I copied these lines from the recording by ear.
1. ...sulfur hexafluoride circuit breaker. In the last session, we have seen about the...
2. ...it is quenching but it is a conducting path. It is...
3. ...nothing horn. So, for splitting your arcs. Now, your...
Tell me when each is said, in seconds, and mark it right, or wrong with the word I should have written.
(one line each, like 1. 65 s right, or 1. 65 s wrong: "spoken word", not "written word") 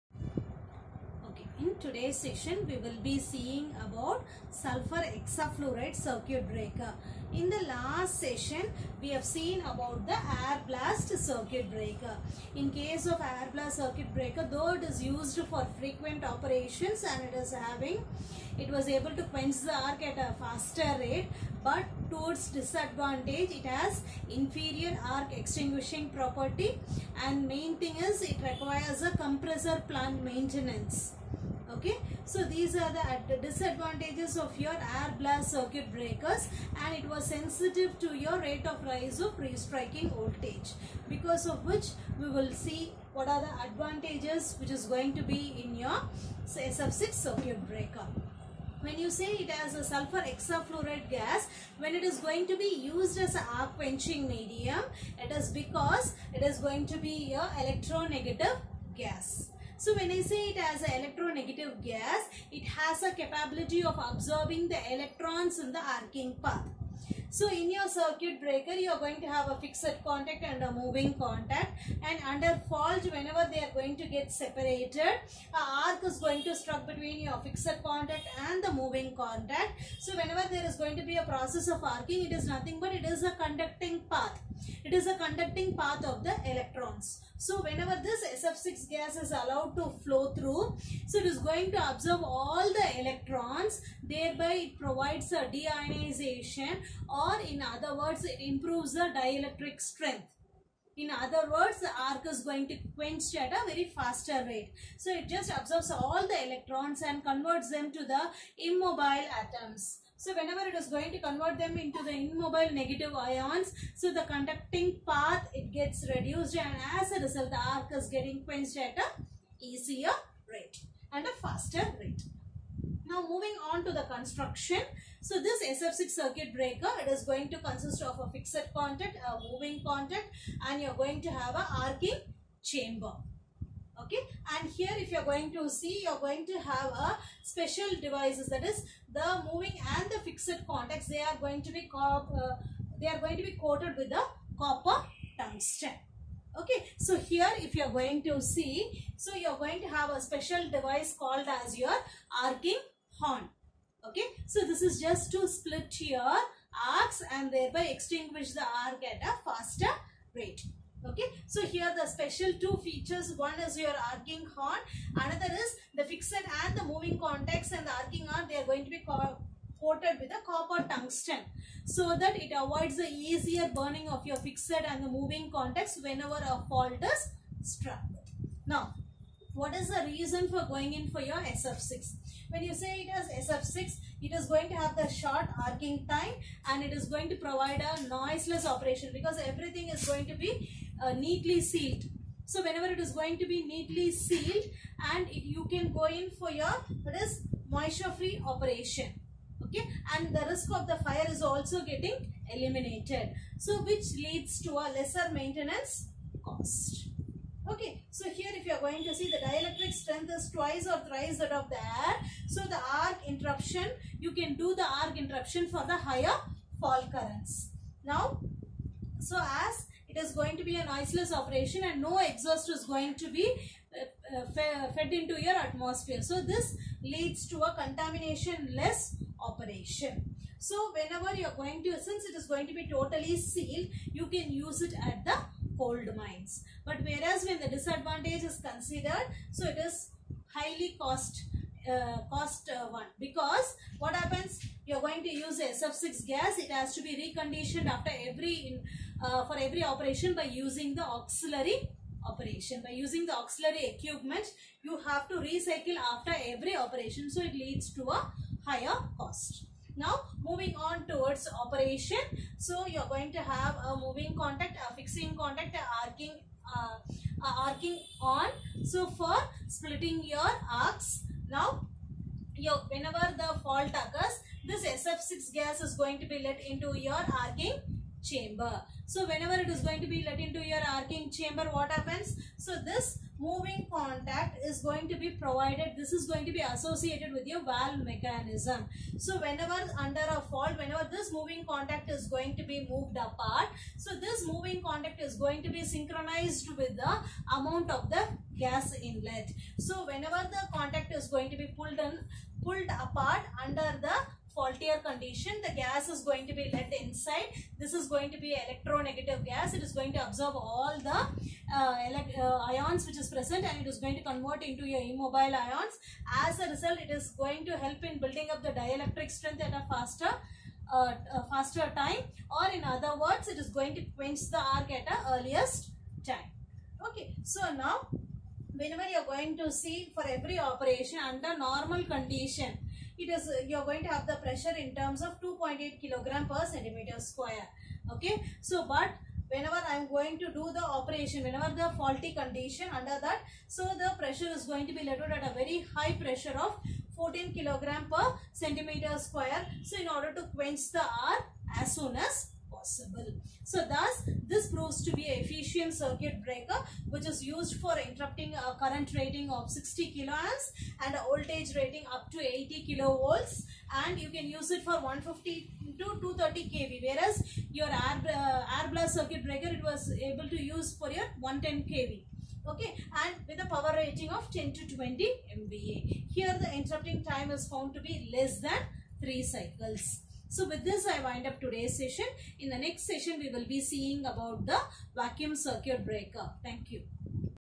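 1. 4 s right
2. 82 s wrong: "nothing", not "quenching"
3. 267 s wrong: "arcing", not "nothing".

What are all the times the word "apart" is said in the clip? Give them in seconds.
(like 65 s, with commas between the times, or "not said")
293 s, 303 s.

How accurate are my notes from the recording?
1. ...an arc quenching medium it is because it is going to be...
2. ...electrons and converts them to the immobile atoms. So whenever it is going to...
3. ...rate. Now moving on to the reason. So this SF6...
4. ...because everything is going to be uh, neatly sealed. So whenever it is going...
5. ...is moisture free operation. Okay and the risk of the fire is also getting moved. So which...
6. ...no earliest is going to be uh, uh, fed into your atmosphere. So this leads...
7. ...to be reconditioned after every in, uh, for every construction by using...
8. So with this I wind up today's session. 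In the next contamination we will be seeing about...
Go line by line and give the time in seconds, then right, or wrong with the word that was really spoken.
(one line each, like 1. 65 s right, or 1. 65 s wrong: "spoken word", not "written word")
1. 53 s right
2. 106 s right
3. 121 s wrong: "construction", not "reason"
4. 189 s right
5. 197 s wrong: "eliminated", not "moved"
6. 222 s wrong: "exhaust", not "earliest"
7. 246 s wrong: "operation", not "construction"
8. 380 s wrong: "session", not "contamination".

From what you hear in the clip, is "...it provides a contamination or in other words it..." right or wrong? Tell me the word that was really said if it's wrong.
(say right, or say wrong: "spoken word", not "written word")
wrong: "deionization", not "contamination".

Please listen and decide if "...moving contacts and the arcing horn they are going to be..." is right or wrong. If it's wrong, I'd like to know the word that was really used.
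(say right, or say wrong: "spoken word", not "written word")
right.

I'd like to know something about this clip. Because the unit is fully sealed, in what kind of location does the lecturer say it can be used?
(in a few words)
cold mines.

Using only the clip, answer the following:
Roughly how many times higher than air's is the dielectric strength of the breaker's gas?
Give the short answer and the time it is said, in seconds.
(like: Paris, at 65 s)
twice or thrice, at 210 s.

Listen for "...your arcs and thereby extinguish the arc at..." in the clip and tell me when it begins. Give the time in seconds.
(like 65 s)
156 s.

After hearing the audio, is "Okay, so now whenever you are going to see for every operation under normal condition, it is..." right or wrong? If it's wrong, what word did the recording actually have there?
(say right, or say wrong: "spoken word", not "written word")
right.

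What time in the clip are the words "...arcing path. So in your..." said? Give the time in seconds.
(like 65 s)
65 s.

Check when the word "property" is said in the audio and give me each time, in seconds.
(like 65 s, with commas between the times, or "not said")
26 s.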